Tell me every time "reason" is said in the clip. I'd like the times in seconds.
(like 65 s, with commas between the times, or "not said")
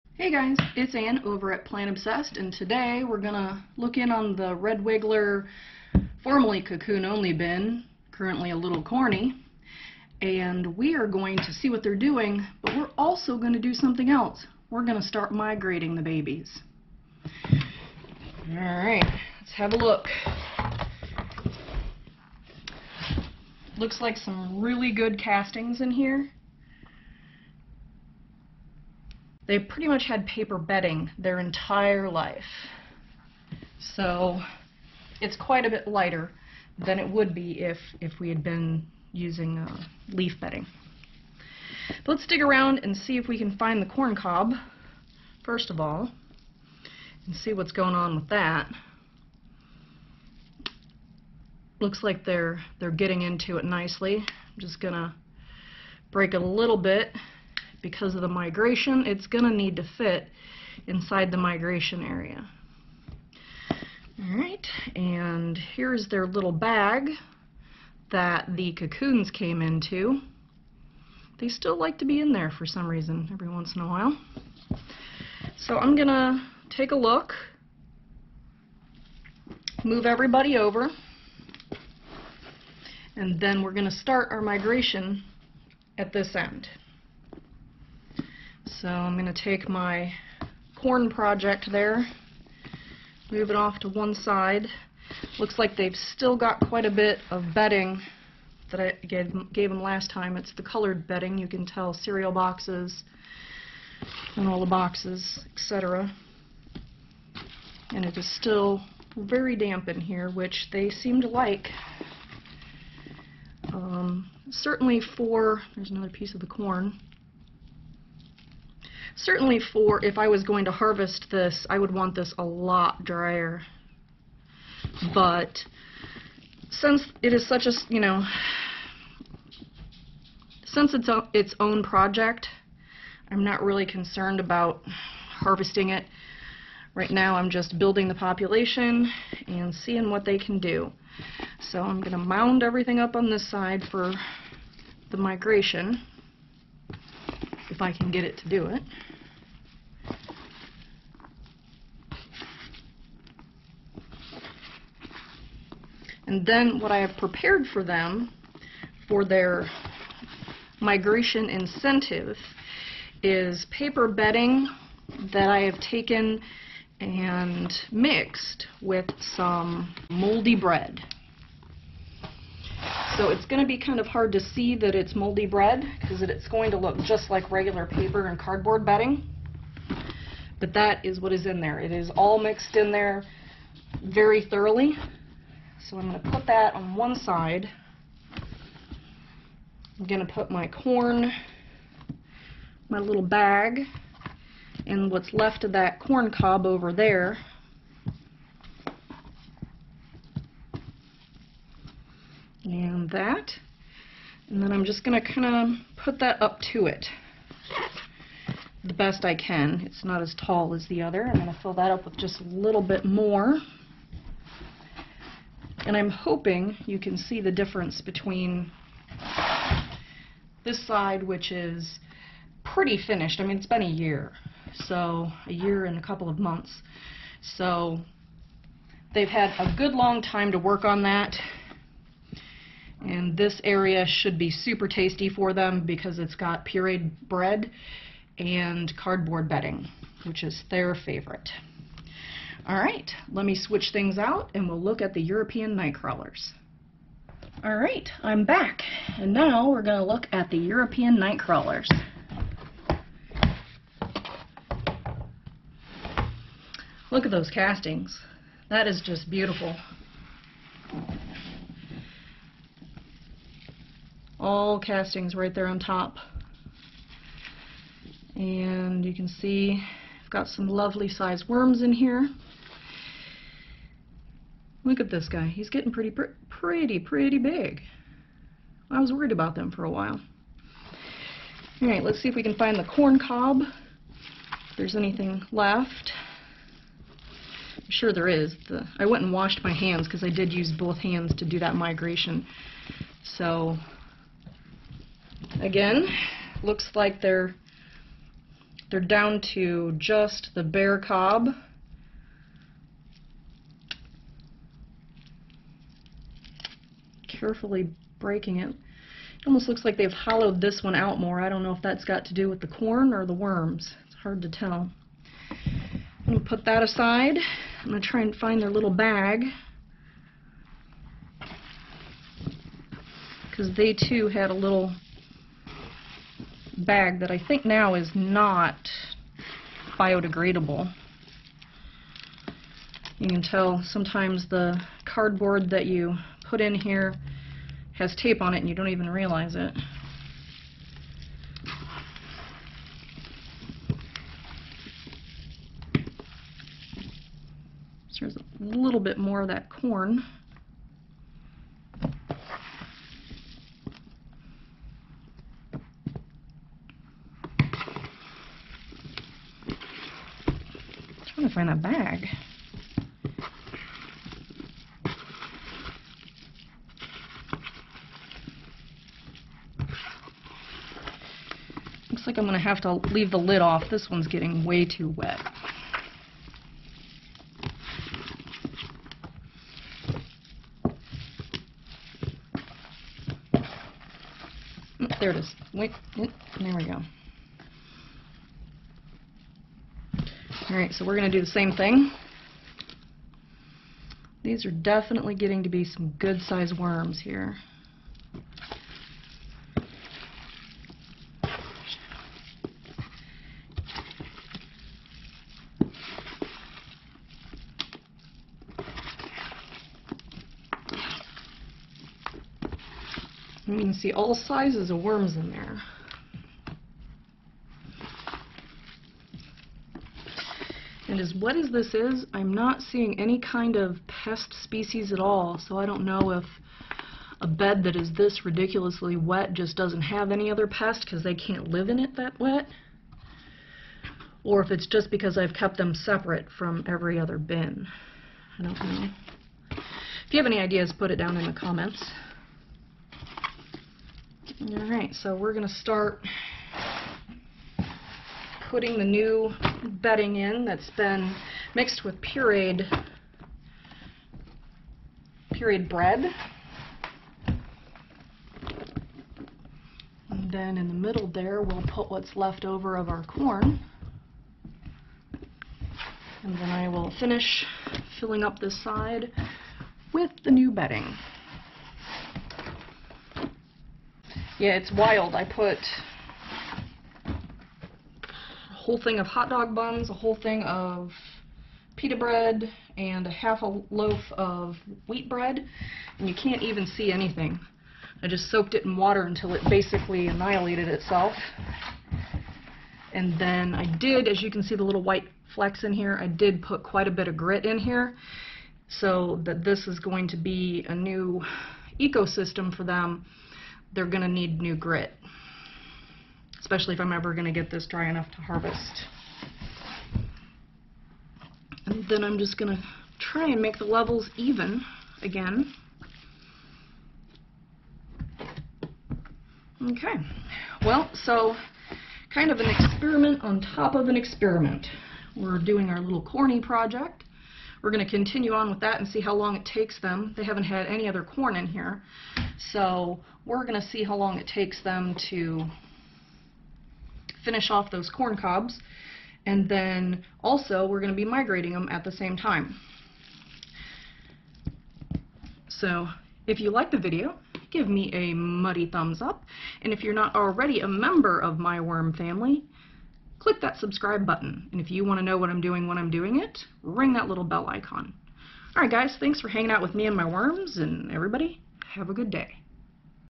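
72 s.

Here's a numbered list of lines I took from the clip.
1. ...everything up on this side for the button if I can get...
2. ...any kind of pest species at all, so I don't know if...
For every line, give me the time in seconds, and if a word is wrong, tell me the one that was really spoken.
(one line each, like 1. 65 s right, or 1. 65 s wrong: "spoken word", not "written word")
1. 142 s wrong: "migration", not "button"
2. 423 s right.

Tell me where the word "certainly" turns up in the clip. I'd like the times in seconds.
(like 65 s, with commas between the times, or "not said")
114 s, 119 s.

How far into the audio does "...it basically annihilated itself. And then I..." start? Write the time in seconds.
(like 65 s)
489 s.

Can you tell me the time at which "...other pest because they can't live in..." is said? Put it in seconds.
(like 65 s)
430 s.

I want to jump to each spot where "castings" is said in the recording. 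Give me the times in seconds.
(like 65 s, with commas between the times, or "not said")
25 s, 257 s, 264 s.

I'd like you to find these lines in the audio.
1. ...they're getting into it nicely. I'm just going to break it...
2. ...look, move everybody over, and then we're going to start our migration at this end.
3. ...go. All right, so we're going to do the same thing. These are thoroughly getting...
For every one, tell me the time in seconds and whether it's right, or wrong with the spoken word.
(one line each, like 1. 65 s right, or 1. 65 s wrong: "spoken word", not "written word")
1. 52 s right
2. 76 s right
3. 386 s wrong: "definitely", not "thoroughly".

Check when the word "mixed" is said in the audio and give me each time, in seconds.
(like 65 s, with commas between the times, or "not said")
167 s, 182 s, 451 s.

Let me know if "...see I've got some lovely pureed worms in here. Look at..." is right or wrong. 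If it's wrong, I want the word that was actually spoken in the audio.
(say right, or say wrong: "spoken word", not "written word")
wrong: "sized", not "pureed".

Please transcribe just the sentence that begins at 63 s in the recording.
All right, and here's their little bag that the cocoons came into.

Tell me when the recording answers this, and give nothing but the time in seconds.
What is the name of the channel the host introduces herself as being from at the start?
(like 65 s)
1 s.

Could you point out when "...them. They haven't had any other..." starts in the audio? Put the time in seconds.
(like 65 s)
529 s.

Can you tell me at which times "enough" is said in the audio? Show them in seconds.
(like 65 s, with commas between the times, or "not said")
508 s.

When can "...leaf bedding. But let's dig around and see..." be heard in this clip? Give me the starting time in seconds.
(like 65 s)
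40 s.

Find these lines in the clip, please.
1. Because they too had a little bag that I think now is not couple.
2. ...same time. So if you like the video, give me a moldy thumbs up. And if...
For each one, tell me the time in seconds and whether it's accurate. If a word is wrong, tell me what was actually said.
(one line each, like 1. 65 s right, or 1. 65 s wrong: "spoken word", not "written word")
1. 323 s wrong: "biodegradable", not "couple"
2. 542 s wrong: "muddy", not "moldy".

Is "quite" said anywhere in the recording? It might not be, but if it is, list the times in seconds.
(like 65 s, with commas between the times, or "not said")
35 s, 96 s, 496 s.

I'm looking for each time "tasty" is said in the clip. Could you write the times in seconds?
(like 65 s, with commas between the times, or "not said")
234 s.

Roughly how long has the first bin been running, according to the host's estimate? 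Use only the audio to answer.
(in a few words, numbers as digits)
a year and a couple of months.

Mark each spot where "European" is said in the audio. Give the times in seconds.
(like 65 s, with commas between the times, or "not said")
245 s, 250 s.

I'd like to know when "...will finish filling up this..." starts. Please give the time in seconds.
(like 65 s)
466 s.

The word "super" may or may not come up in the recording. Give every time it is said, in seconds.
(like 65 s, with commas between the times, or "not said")
234 s.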